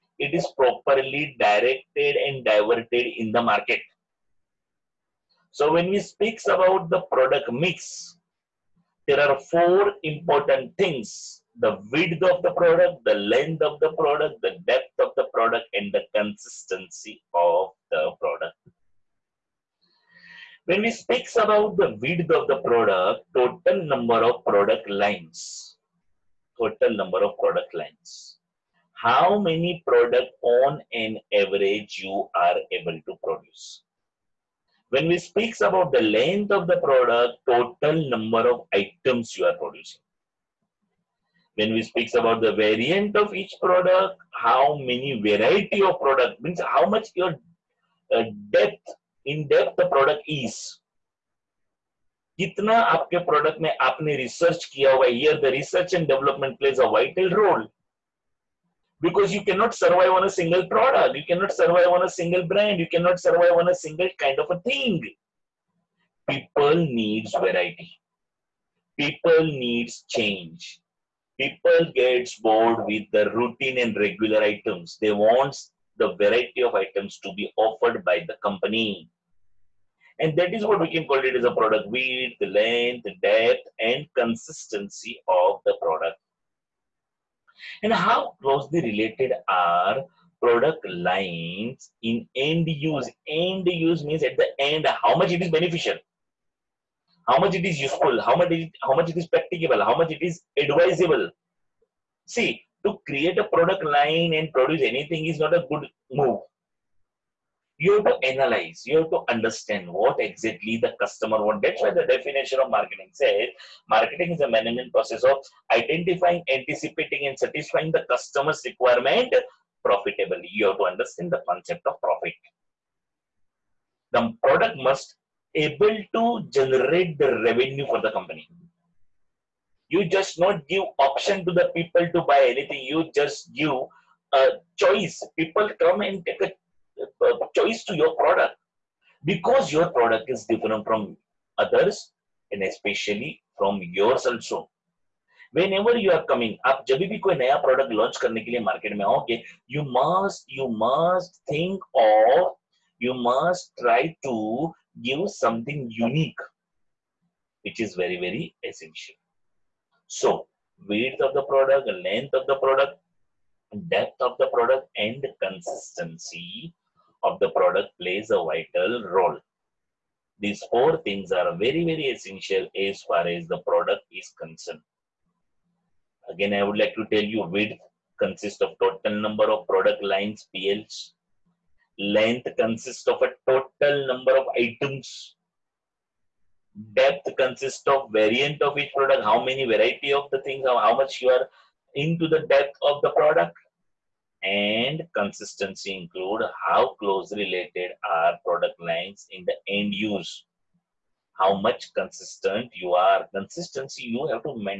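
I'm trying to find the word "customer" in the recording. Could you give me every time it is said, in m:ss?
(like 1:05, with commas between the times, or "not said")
1:51, 1:58.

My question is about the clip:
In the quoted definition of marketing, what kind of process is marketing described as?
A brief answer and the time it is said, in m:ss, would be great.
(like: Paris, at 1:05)
Management process, at 1:54.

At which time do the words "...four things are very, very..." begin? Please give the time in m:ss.
2:50.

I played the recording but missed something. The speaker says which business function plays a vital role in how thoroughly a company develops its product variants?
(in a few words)
Research and development.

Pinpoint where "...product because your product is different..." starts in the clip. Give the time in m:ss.
2:18.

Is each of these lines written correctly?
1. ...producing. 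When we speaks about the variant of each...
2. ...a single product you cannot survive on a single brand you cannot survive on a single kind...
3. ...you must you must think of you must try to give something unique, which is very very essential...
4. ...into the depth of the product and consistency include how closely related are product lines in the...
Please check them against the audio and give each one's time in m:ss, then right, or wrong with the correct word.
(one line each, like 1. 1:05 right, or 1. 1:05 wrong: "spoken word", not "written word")
1. 0:39 right
2. 1:00 right
3. 2:29 right
4. 3:11 right.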